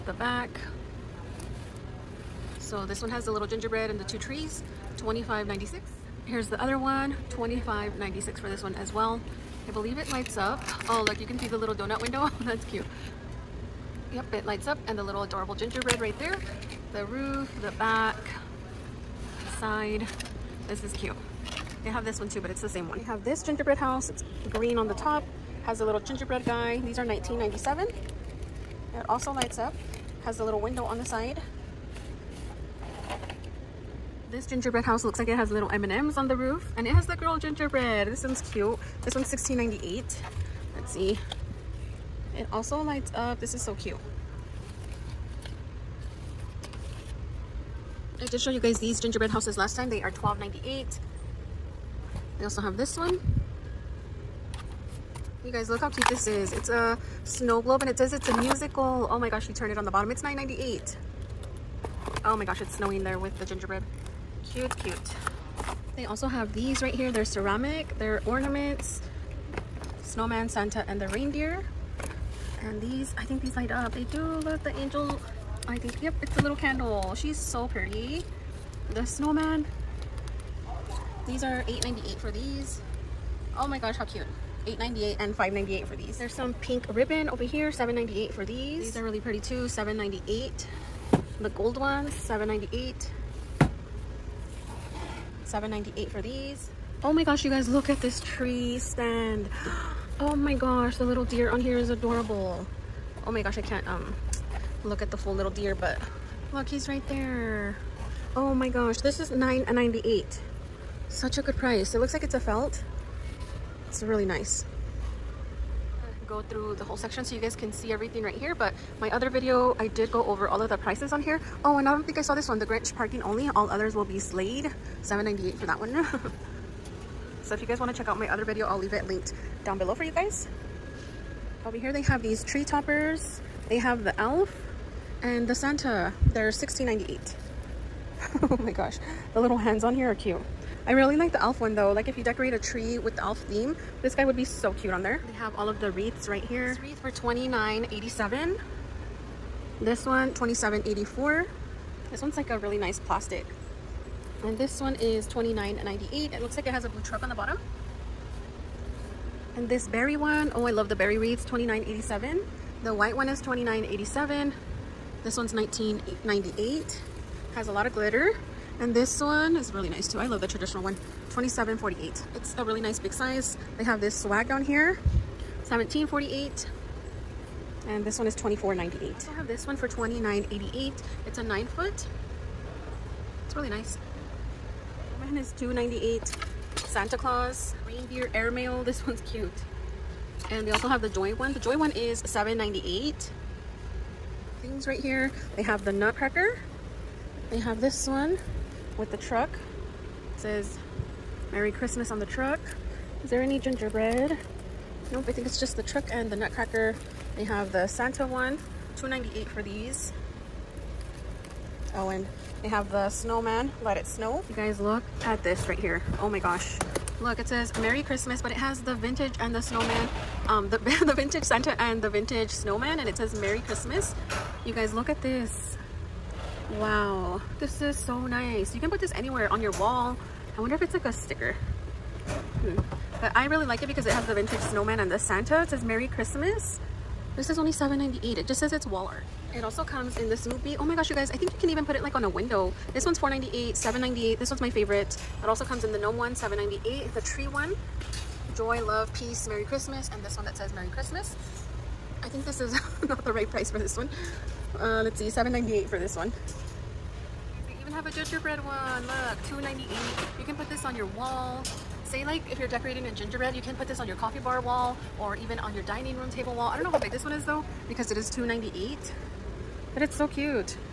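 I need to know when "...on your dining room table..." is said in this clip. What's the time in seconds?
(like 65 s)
265 s.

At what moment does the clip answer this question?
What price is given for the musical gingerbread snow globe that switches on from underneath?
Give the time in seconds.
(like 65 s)
60 s.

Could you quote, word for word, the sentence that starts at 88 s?
These are really pretty too, 7.98.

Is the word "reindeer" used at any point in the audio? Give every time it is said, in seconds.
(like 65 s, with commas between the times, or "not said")
71 s, 187 s.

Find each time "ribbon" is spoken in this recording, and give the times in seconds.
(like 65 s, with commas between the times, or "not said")
86 s.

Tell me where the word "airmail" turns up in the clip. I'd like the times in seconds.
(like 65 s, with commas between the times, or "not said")
188 s.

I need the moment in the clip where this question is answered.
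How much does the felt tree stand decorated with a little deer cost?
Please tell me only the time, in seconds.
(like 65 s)
109 s.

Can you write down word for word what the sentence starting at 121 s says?
Oh, and I don't think I saw this one, the Grinch parking only.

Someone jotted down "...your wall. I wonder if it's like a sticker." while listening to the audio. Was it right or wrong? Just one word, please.
right.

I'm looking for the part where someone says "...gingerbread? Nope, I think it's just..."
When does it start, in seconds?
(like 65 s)
203 s.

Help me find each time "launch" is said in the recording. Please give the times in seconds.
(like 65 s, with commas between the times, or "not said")
not said.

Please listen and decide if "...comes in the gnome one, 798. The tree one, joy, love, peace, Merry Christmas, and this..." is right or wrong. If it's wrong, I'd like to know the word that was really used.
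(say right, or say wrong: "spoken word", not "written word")
right.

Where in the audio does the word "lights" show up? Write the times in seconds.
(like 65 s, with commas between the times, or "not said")
10 s, 14 s, 29 s, 42 s, 73 s.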